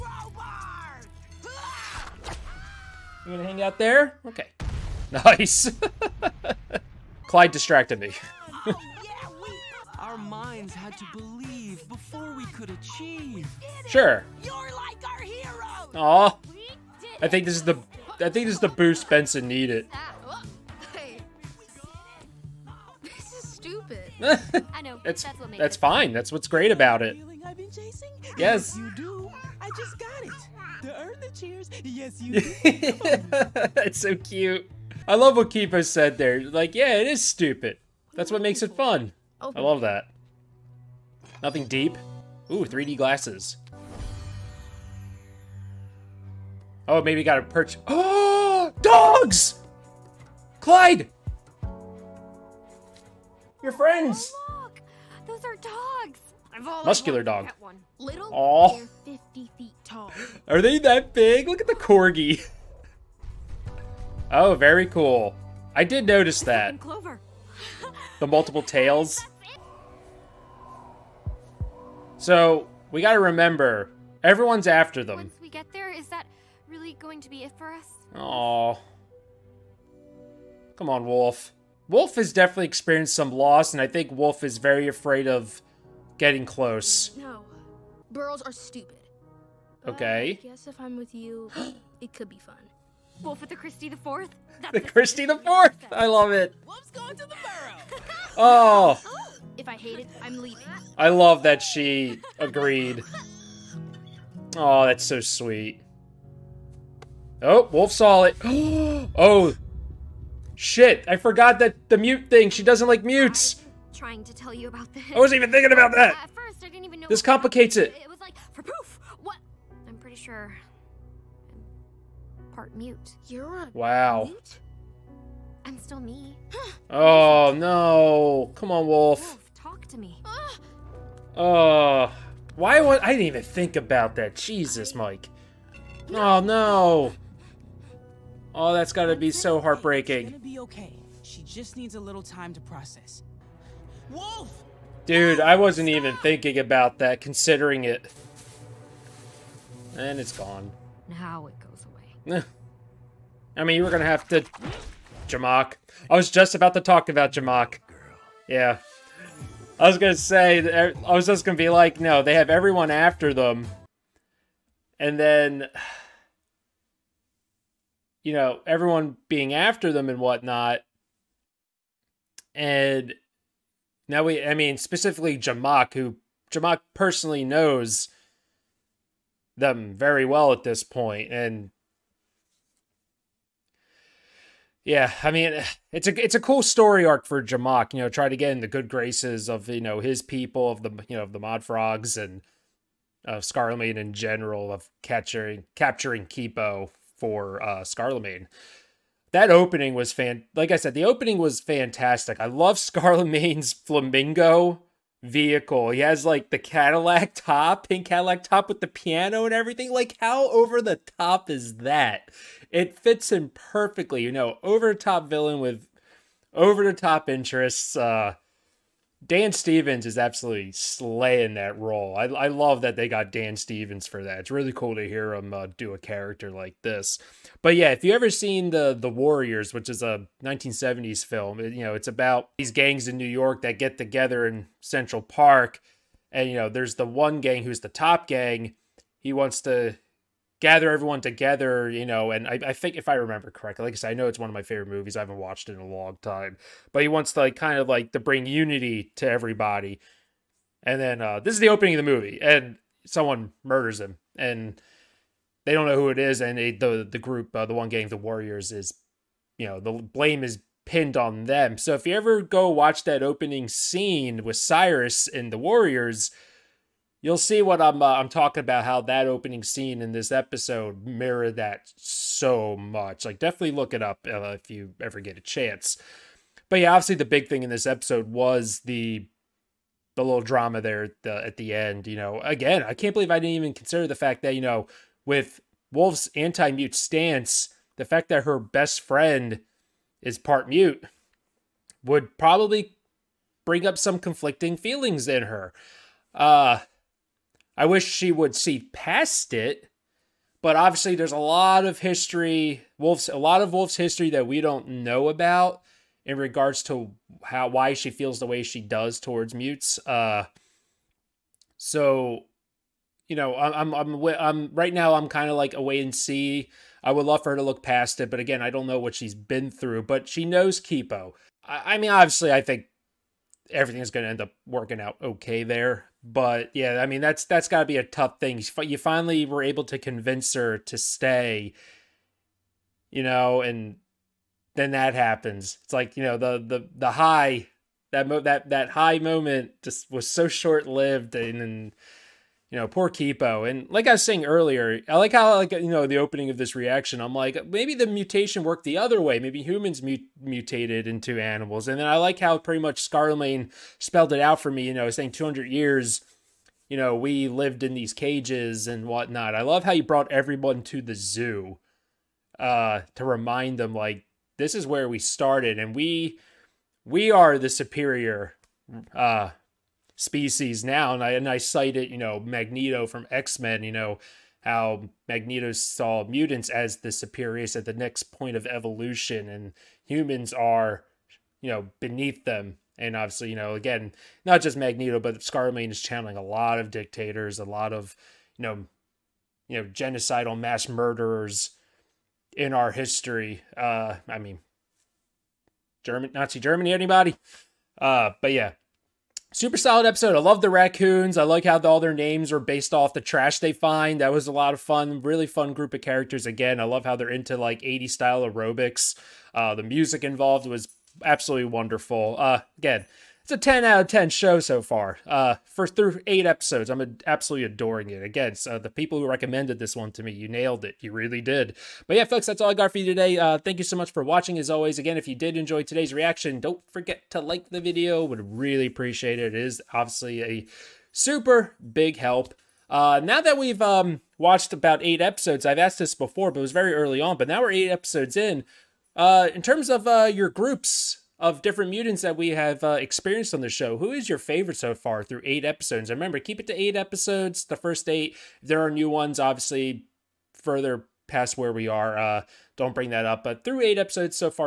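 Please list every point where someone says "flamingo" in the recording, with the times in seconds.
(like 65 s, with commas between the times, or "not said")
203 s.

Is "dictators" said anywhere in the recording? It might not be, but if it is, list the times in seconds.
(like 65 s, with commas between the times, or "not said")
386 s.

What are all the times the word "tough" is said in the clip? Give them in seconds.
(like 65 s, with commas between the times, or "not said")
328 s.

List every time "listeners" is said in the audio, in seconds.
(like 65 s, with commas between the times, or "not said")
not said.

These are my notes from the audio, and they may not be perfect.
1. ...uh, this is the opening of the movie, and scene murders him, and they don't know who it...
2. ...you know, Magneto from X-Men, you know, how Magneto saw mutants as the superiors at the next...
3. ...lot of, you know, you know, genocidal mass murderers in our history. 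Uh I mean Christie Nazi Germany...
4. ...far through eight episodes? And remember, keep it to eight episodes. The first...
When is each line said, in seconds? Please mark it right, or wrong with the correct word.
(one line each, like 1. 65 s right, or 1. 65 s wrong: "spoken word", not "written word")
1. 251 s wrong: "someone", not "scene"
2. 372 s right
3. 387 s wrong: "German", not "Christie"
4. 444 s right.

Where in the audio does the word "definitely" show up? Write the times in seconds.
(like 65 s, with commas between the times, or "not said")
82 s, 273 s.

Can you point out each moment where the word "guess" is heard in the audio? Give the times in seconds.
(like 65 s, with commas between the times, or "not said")
90 s.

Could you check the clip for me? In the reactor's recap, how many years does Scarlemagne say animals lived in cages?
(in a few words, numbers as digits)
200.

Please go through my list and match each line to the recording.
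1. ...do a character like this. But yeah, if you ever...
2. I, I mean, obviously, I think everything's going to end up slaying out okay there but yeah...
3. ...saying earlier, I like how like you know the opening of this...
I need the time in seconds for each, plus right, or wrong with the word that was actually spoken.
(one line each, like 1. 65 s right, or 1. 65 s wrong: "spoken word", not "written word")
1. 225 s right
2. 321 s wrong: "working", not "slaying"
3. 344 s right.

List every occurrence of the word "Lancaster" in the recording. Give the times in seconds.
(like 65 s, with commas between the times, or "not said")
not said.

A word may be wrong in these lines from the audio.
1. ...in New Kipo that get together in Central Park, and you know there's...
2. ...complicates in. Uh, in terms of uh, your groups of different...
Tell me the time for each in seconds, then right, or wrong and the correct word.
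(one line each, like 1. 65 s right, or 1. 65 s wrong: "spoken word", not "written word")
1. 233 s wrong: "York", not "Kipo"
2. 437 s wrong: "episodes", not "complicates".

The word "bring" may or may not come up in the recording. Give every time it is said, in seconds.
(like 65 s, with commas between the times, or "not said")
248 s, 293 s, 452 s.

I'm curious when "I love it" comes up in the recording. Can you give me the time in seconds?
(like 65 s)
95 s.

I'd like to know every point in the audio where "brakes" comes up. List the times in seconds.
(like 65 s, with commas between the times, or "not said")
not said.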